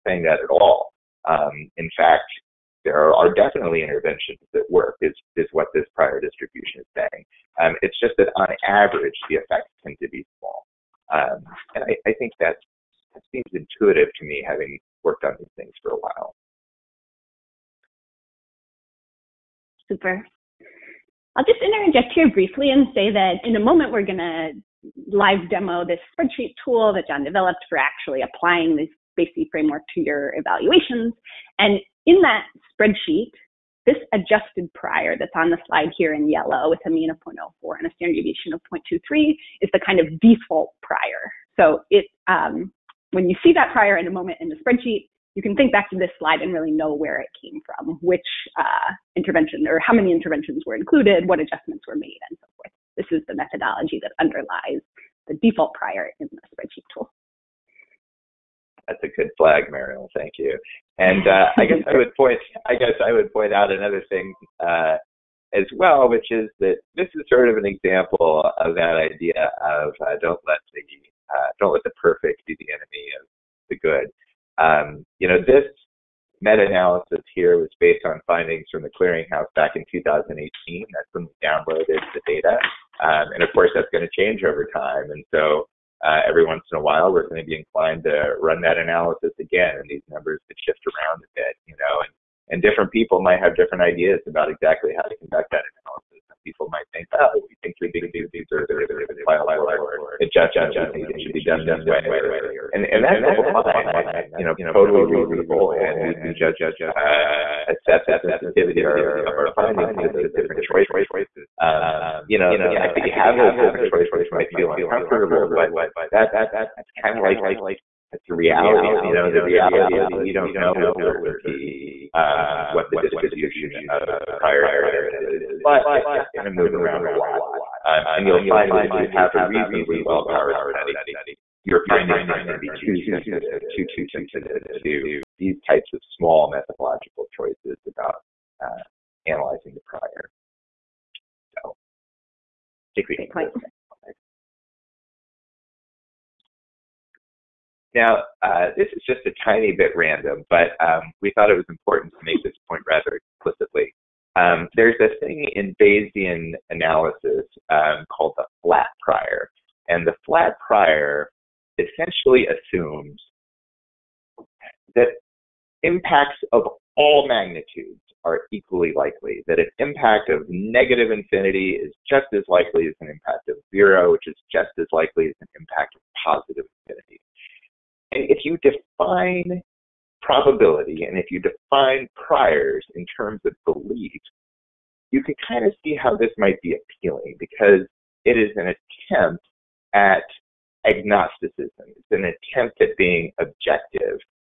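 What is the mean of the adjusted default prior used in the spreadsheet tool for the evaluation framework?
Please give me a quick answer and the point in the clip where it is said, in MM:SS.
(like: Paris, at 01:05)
0.04, at 00:36.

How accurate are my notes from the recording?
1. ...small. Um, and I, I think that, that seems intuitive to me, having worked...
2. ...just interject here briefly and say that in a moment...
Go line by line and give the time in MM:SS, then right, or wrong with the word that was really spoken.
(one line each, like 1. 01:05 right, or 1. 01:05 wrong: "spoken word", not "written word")
1. 00:10 right
2. 00:21 right.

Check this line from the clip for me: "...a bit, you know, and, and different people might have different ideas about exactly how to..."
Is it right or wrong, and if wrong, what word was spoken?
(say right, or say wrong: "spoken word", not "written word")
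right.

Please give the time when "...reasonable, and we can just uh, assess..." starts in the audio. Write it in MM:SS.
01:45.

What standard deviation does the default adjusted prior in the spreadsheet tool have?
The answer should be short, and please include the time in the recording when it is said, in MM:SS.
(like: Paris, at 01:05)
0.23, at 00:37.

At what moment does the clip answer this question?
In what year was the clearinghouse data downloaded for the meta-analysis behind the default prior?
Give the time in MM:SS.
01:19.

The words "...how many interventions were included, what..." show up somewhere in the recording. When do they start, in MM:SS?
00:49.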